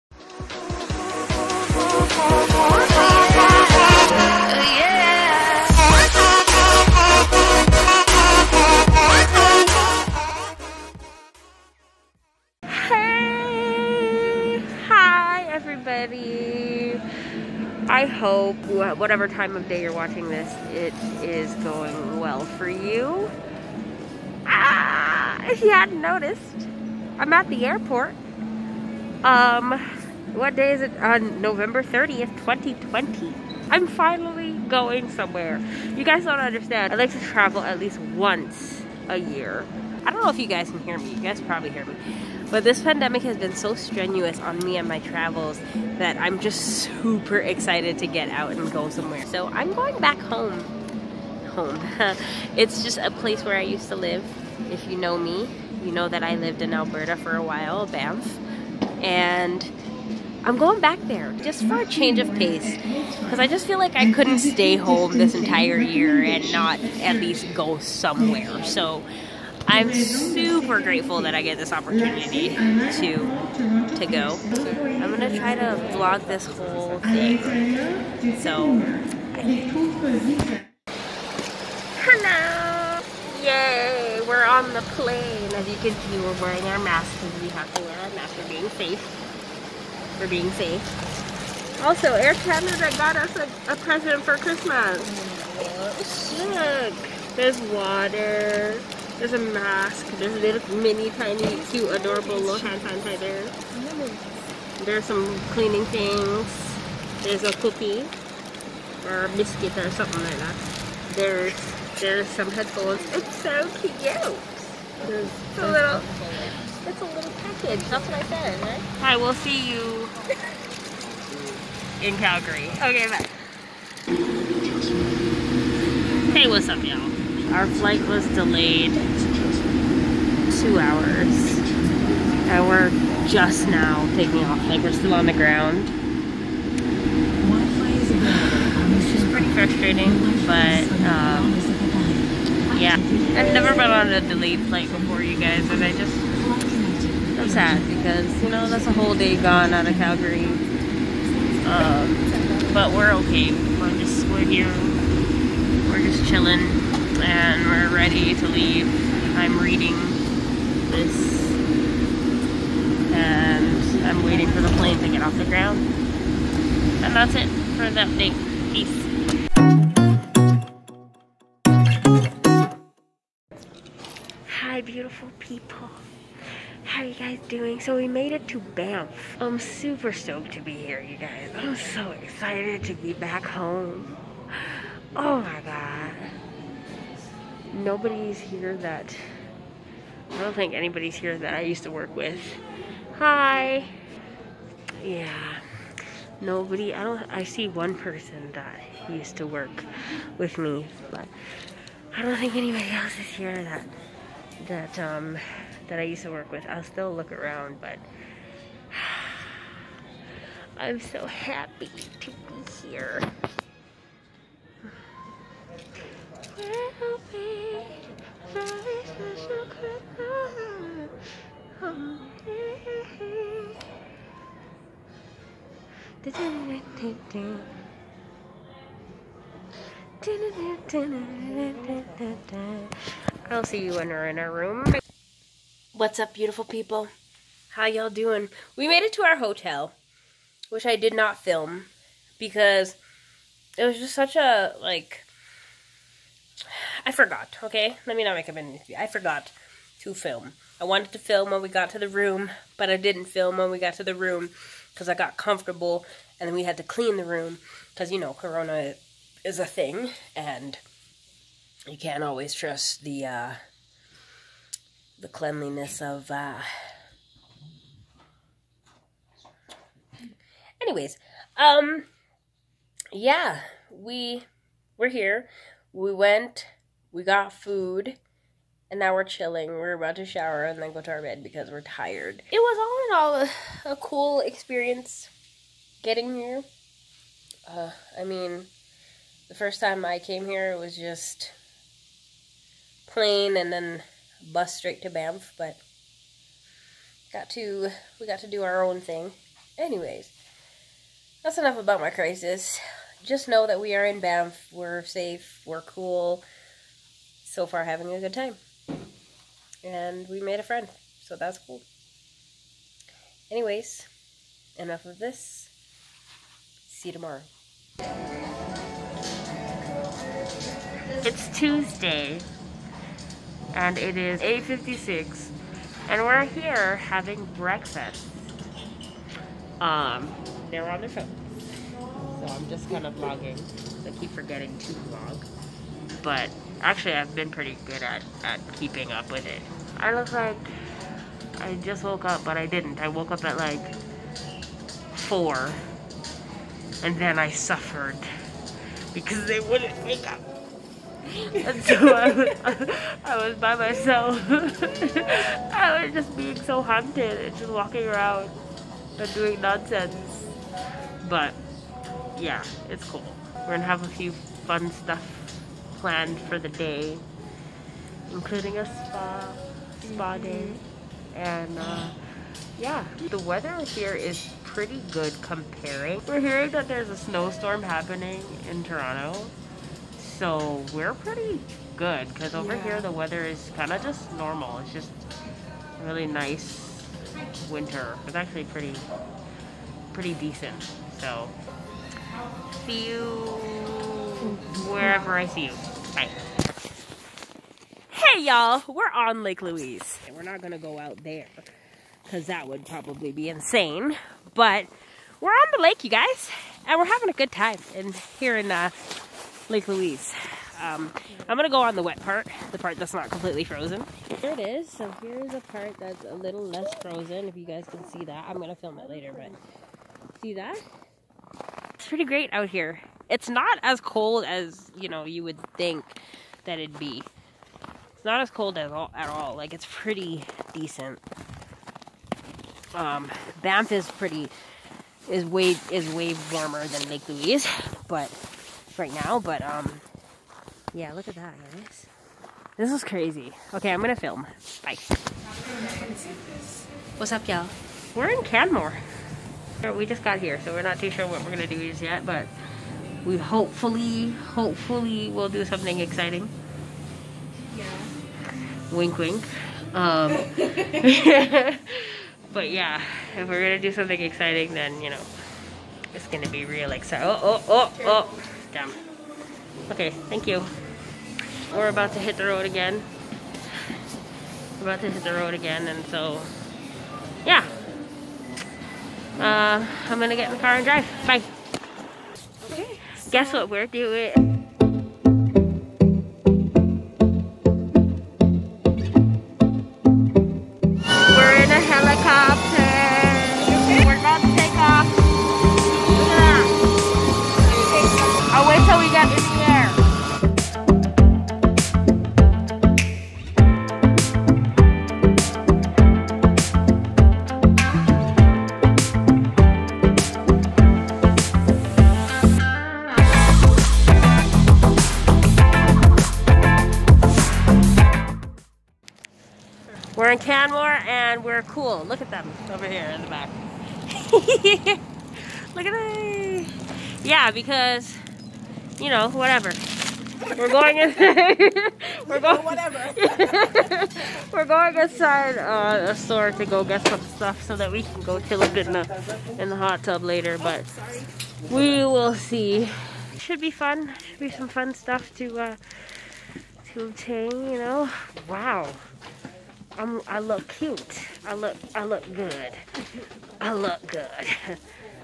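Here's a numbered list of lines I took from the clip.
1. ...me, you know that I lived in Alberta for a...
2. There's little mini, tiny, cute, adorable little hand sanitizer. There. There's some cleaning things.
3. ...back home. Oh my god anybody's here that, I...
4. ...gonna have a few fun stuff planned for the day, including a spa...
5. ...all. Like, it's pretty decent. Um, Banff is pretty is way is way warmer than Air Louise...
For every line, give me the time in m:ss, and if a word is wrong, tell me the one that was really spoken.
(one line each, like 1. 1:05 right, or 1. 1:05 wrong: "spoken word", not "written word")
1. 0:55 right
2. 1:40 right
3. 3:03 wrong: "nobody", not "anybody"
4. 6:03 right
5. 7:09 wrong: "Lake", not "Air".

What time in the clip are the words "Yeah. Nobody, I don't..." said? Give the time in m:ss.
3:15.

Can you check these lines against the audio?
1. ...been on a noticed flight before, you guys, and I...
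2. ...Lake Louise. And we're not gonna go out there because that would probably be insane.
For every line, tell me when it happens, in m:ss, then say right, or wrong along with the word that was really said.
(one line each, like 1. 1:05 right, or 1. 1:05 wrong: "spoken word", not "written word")
1. 2:23 wrong: "delayed", not "noticed"
2. 6:39 right.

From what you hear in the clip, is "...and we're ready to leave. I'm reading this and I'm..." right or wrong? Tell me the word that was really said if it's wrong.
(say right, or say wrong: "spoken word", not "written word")
right.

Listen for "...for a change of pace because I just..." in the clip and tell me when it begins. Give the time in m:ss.
1:01.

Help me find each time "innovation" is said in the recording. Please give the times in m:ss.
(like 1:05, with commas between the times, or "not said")
not said.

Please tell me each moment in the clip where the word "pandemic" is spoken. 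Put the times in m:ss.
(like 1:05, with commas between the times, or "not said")
0:42.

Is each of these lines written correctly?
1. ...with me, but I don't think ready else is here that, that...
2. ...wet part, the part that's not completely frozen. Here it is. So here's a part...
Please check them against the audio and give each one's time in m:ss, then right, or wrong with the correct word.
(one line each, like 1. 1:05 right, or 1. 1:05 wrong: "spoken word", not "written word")
1. 3:20 wrong: "anybody", not "ready"
2. 6:52 right.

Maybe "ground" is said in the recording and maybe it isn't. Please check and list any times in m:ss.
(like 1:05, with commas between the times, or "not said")
2:15, 2:45.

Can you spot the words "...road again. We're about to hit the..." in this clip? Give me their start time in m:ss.
7:52.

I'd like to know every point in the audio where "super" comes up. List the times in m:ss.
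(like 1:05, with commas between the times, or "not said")
0:47, 1:09, 2:59.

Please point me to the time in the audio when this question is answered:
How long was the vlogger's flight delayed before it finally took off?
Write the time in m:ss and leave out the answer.
2:08.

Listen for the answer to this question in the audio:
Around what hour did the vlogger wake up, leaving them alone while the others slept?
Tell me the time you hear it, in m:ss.
5:45.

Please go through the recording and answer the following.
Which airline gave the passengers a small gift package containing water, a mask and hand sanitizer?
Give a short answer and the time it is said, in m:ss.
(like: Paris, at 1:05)
Air Canada, at 1:32.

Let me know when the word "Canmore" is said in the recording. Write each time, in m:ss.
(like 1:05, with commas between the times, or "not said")
7:28.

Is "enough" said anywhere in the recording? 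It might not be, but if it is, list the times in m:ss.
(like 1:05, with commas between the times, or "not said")
5:01, 5:14.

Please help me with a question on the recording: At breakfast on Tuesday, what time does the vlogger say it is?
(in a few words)
8:56.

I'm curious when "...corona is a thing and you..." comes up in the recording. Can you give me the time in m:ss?
4:18.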